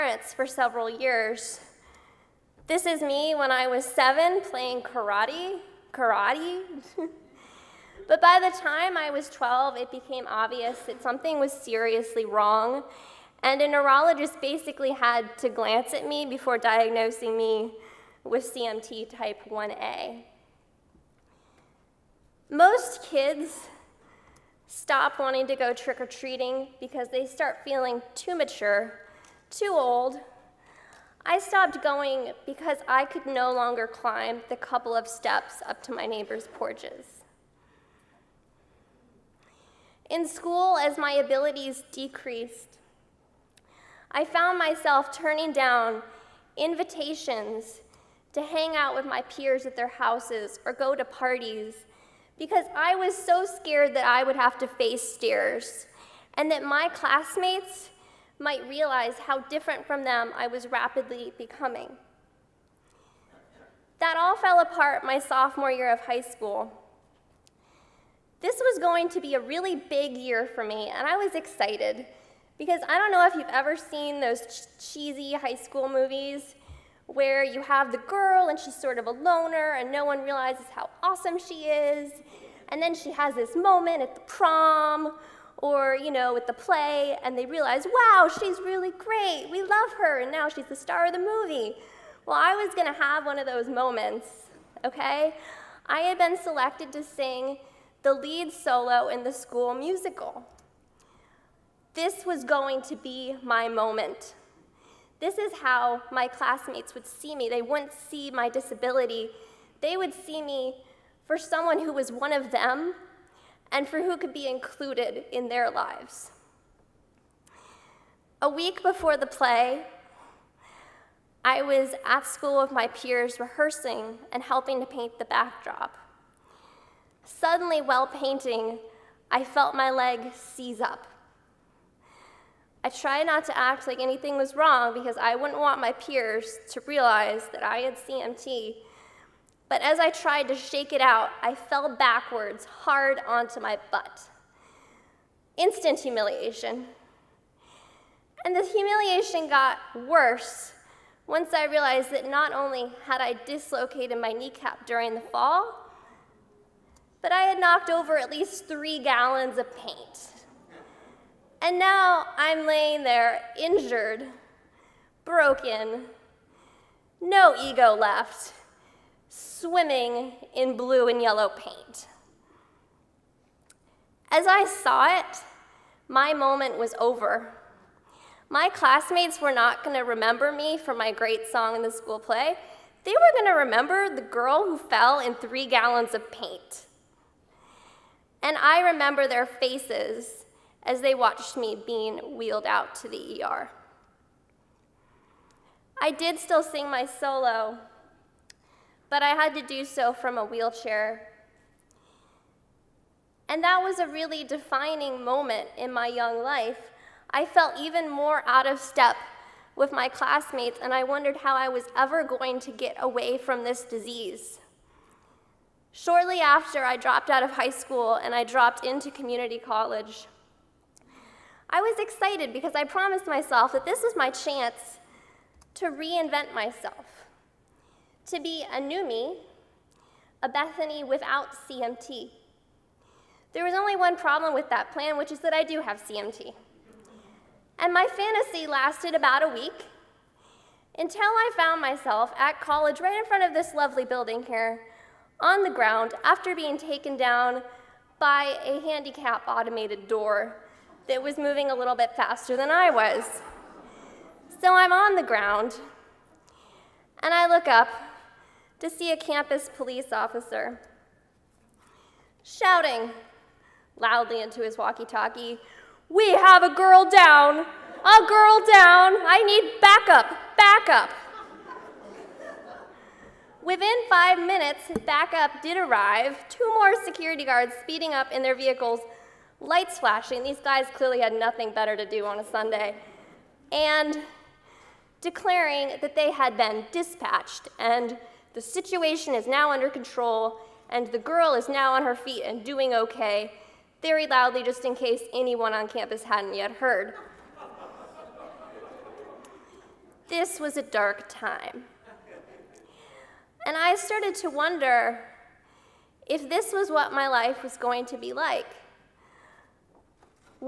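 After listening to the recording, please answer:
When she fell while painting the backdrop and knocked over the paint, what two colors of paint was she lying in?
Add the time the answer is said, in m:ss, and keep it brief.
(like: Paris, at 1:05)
blue and yellow, at 2:50.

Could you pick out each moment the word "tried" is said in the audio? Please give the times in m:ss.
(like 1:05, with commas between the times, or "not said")
2:12, 2:20.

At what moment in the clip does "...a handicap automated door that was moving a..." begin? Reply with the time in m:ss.
4:08.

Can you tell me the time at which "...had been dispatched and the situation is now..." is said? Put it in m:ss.
4:46.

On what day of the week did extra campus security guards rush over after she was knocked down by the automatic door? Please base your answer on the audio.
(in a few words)
Sunday.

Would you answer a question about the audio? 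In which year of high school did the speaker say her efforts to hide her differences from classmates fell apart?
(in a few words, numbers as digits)
sophomore year.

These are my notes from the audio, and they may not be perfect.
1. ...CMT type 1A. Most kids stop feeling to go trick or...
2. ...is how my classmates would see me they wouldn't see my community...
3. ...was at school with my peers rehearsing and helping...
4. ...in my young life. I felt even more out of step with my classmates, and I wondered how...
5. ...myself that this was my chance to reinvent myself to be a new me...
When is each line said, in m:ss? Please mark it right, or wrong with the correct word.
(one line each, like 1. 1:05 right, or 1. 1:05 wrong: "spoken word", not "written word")
1. 0:18 wrong: "wanting", not "feeling"
2. 1:45 wrong: "disability", not "community"
3. 2:01 right
4. 3:25 right
5. 3:43 right.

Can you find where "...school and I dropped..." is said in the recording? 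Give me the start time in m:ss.
3:37.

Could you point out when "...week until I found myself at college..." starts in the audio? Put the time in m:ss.
3:59.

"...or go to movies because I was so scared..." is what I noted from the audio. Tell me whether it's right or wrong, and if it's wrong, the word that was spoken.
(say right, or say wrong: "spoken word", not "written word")
wrong: "parties", not "movies".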